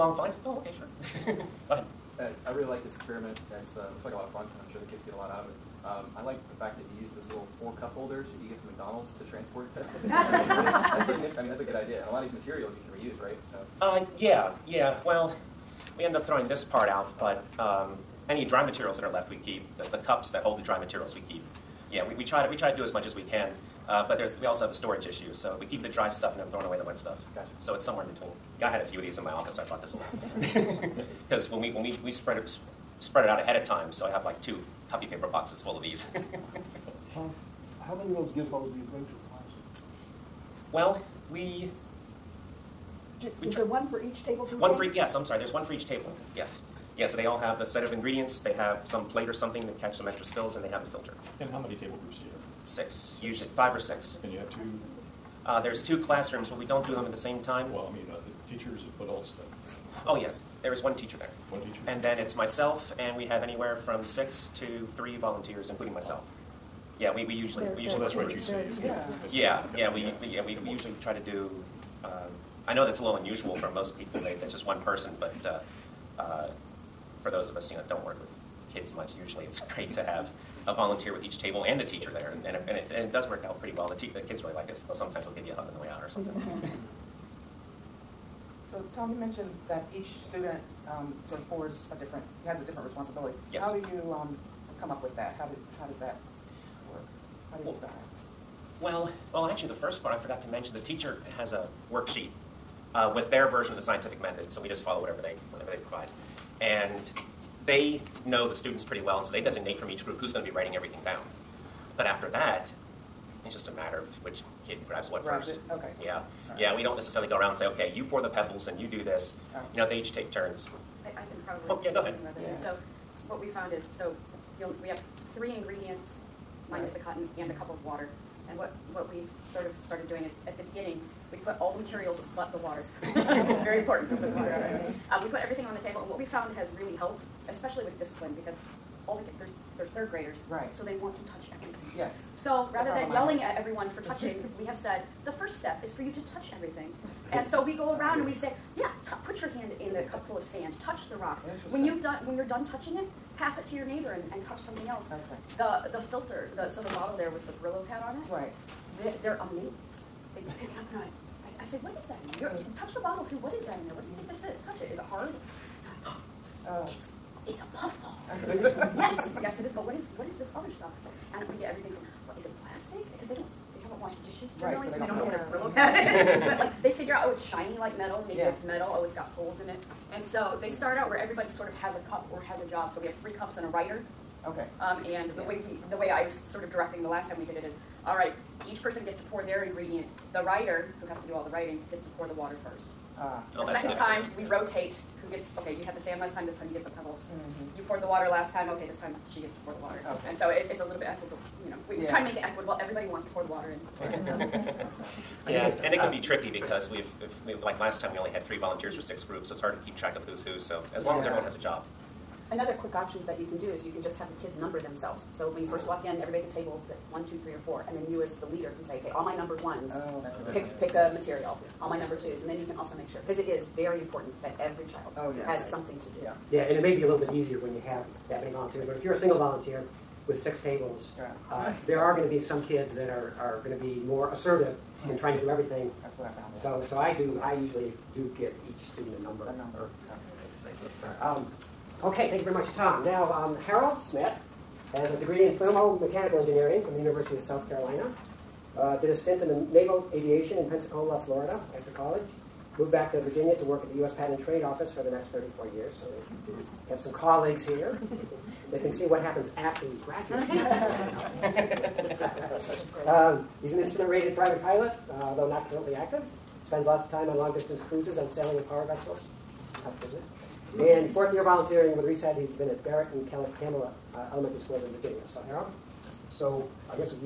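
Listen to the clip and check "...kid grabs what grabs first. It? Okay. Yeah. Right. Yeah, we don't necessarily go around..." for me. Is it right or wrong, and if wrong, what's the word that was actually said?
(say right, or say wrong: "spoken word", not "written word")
right.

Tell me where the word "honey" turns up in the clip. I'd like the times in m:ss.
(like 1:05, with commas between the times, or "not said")
not said.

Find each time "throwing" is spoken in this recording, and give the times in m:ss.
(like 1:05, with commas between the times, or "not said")
0:16, 0:26.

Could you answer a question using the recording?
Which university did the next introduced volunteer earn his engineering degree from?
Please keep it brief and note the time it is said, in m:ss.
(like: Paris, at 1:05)
University of South Carolina, at 4:06.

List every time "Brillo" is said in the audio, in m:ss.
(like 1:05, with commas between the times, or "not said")
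2:37, 2:55.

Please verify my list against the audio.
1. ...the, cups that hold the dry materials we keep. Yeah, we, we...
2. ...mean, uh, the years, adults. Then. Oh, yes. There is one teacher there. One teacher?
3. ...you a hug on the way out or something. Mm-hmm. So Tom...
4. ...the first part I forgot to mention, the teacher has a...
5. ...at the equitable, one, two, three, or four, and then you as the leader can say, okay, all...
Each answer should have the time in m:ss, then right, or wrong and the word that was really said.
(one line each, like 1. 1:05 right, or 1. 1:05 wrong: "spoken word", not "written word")
1. 0:19 right
2. 0:57 wrong: "teachers", not "years"
3. 1:25 right
4. 1:39 right
5. 3:36 wrong: "table", not "equitable".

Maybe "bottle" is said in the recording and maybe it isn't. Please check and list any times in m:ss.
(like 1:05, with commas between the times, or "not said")
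2:36, 2:42.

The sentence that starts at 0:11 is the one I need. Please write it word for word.
I mean, that's a good idea.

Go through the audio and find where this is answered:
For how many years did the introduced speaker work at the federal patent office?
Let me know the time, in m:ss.
4:15.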